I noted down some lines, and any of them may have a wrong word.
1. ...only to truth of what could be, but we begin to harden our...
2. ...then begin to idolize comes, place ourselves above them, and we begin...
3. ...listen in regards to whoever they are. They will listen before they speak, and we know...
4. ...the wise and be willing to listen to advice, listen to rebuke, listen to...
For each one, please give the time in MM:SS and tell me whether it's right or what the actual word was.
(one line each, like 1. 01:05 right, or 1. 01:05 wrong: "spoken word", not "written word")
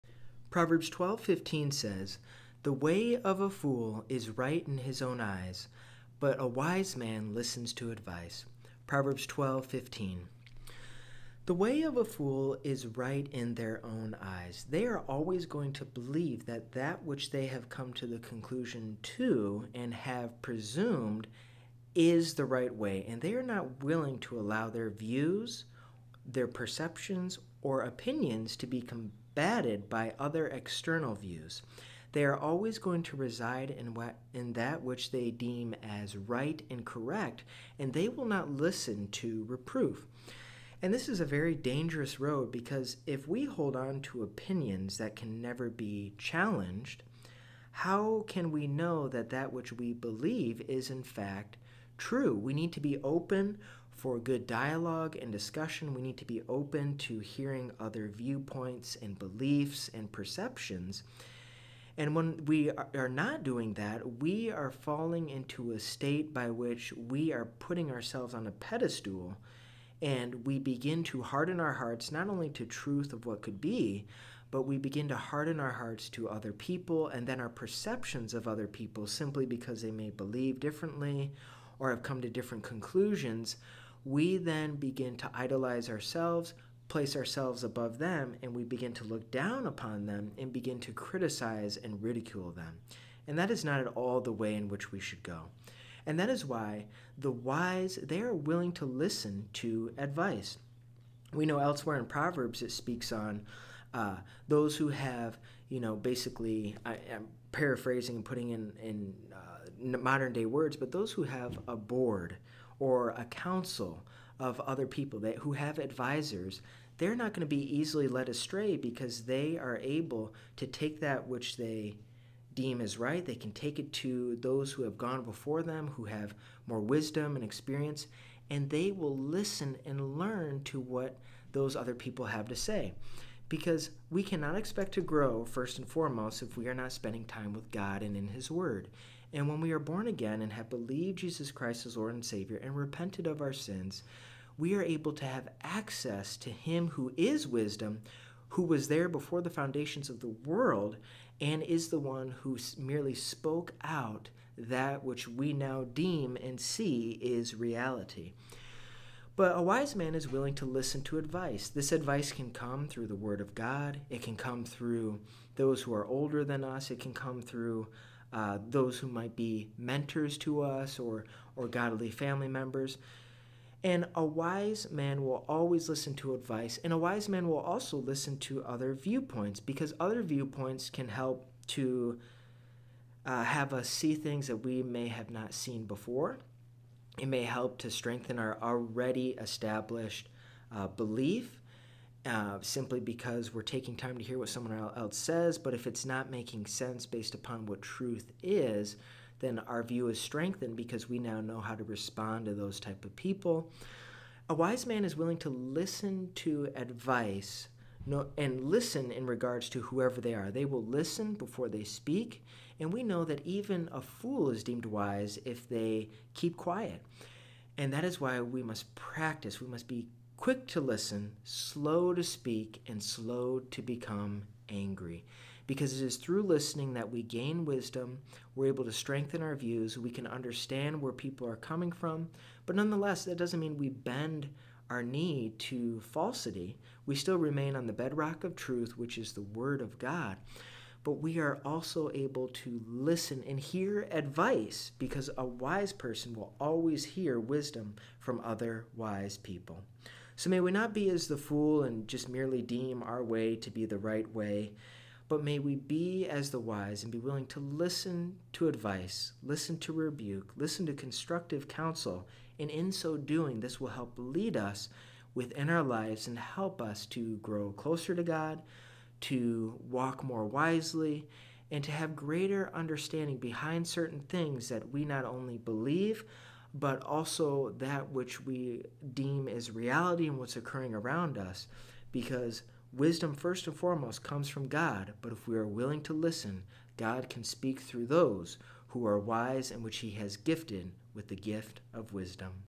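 1. 01:12 right
2. 01:24 wrong: "ourselves", not "comes"
3. 03:28 right
4. 04:16 right.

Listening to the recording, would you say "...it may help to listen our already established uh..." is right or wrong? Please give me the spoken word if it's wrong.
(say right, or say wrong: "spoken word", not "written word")
wrong: "strengthen", not "listen".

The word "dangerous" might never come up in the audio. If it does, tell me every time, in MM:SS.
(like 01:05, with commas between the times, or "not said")
00:41.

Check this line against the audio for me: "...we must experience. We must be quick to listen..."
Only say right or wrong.
wrong.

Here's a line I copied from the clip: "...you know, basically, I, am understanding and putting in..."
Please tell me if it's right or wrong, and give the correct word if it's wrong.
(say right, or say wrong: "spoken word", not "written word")
wrong: "paraphrasing", not "understanding".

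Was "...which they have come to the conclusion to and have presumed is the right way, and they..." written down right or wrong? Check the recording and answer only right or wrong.
right.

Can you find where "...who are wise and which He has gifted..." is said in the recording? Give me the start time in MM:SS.
04:48.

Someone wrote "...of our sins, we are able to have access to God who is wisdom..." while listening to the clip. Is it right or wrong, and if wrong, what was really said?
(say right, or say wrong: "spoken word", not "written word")
wrong: "Him", not "God".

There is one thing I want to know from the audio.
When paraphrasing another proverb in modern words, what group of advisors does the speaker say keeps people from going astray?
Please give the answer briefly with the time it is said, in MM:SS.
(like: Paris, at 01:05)
a board or a council, at 01:51.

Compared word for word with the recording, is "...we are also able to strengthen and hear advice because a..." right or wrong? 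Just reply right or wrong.
wrong.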